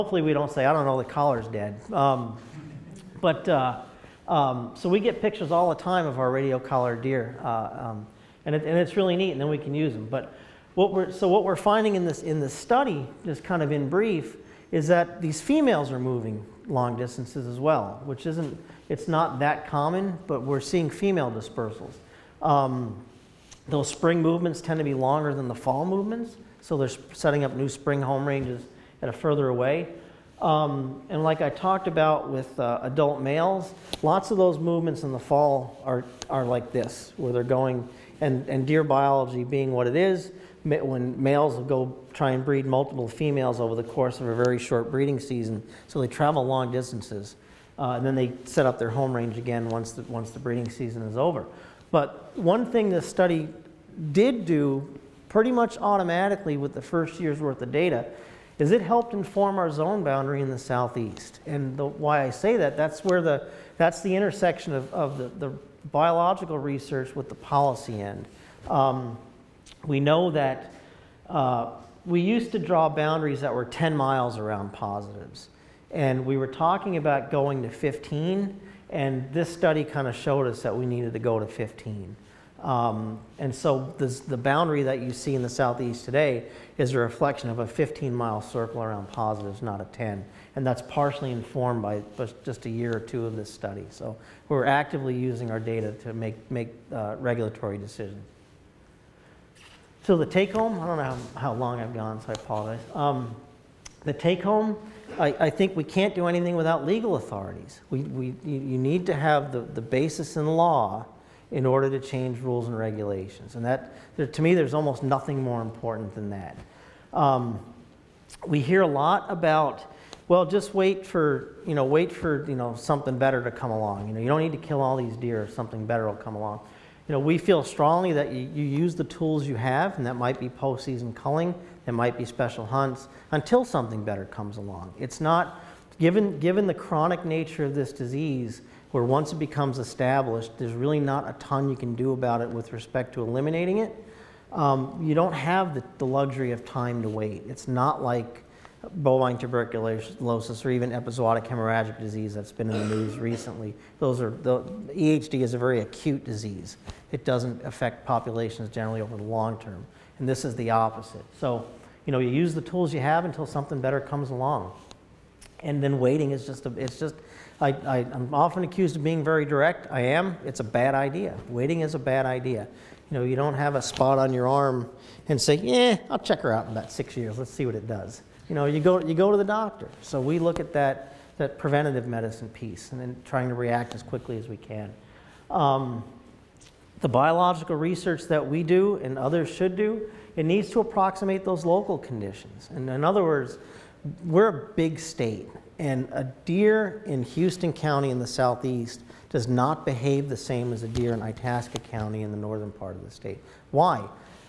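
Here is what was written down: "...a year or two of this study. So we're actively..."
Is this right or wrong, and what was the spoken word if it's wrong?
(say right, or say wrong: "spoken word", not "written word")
right.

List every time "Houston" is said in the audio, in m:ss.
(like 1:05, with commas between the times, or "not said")
3:17.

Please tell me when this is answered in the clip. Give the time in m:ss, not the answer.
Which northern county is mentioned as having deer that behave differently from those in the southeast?
3:21.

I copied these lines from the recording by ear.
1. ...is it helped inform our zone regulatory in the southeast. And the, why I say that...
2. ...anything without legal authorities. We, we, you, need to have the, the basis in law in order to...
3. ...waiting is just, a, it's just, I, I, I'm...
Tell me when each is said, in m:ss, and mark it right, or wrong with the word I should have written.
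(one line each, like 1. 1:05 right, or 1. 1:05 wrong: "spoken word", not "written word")
1. 0:58 wrong: "boundary", not "regulatory"
2. 1:46 right
3. 2:45 right.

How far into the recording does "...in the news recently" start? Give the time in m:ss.
2:32.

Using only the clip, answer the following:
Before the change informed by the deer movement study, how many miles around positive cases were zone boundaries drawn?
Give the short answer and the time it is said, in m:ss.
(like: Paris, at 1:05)
10, at 1:13.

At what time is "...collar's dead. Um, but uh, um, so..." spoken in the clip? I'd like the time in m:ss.
0:01.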